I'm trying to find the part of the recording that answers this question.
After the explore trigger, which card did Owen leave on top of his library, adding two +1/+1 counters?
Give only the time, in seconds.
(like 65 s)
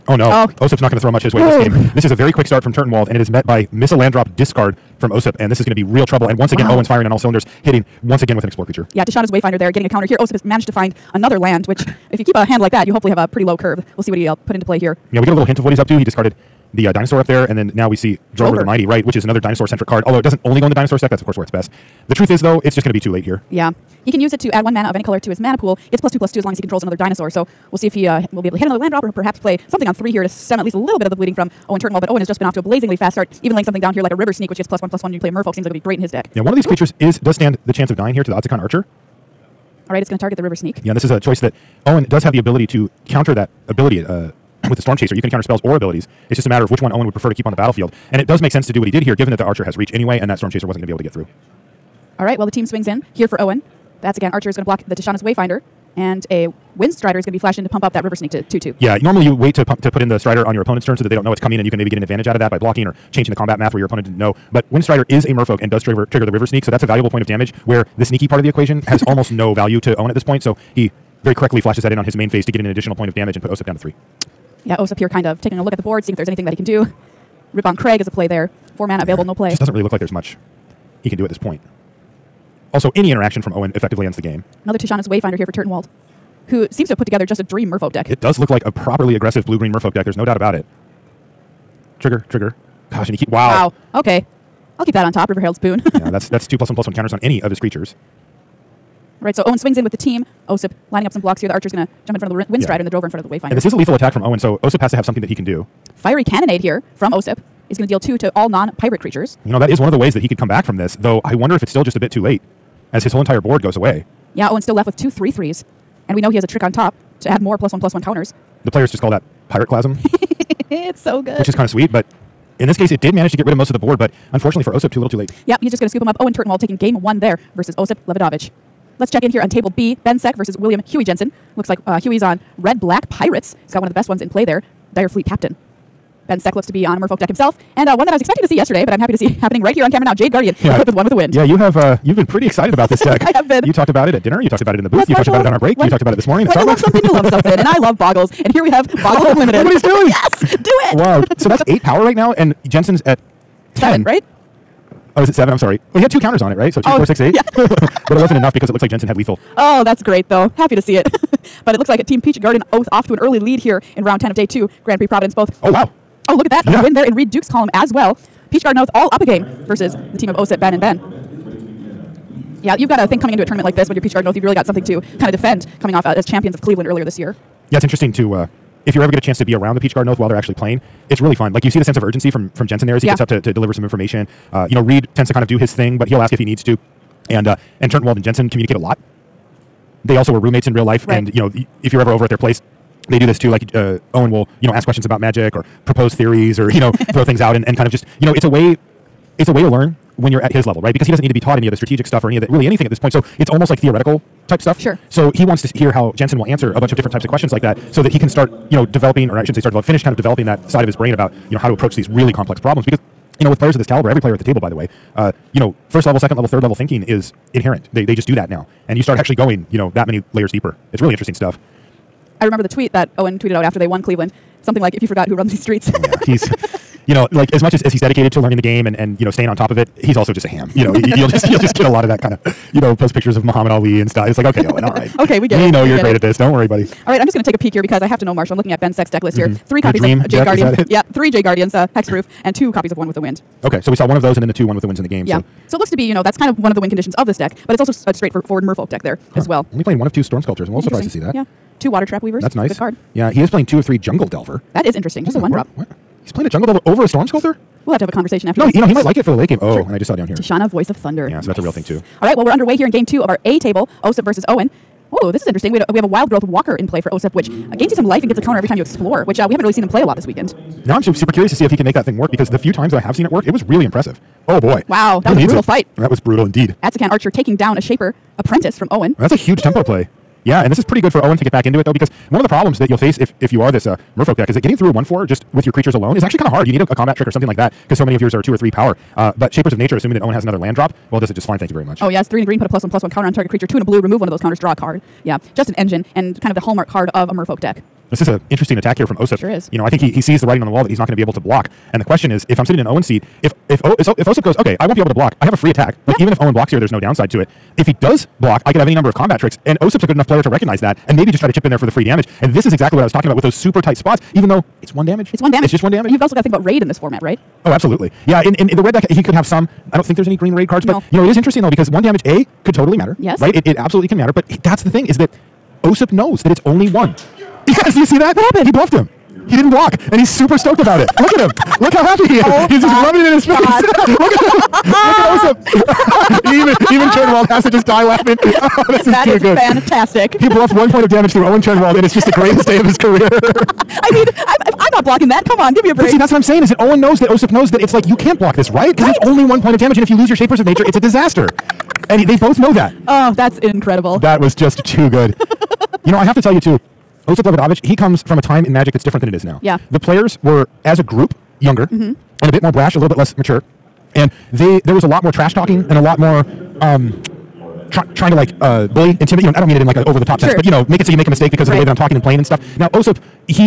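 95 s.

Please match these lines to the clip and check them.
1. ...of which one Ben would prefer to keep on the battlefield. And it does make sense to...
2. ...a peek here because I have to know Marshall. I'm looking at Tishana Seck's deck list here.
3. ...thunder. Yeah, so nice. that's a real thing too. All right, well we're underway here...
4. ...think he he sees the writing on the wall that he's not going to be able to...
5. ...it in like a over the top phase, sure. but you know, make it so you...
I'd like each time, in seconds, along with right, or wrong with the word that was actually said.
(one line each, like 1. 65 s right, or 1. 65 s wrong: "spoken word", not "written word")
1. 46 s wrong: "Owen", not "Ben"
2. 237 s wrong: "Ben", not "Tishana"
3. 260 s right
4. 299 s right
5. 369 s wrong: "sense", not "phase".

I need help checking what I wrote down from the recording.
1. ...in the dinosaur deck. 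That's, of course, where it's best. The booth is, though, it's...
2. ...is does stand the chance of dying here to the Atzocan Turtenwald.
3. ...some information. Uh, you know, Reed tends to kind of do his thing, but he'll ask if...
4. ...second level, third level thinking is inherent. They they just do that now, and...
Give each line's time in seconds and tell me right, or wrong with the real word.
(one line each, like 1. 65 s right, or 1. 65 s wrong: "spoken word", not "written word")
1. 20 s wrong: "truth", not "booth"
2. 37 s wrong: "Archer", not "Turtenwald"
3. 183 s right
4. 216 s right.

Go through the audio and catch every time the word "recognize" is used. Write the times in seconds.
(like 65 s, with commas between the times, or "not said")
310 s.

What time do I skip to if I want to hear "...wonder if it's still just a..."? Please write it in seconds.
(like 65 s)
111 s.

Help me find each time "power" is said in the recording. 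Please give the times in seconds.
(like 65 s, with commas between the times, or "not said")
151 s, 288 s.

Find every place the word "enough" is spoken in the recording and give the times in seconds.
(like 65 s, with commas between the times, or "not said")
158 s, 310 s.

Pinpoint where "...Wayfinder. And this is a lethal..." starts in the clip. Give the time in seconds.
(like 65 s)
103 s.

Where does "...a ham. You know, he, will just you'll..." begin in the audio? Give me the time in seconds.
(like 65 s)
230 s.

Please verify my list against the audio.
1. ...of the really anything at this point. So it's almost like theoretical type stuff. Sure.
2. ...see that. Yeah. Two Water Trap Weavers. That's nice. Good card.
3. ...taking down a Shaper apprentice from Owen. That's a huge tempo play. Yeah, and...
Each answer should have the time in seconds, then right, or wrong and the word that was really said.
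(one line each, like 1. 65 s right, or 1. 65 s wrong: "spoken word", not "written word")
1. 202 s right
2. 251 s right
3. 277 s right.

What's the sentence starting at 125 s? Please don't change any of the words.
Yep, he's just going to scoop him up.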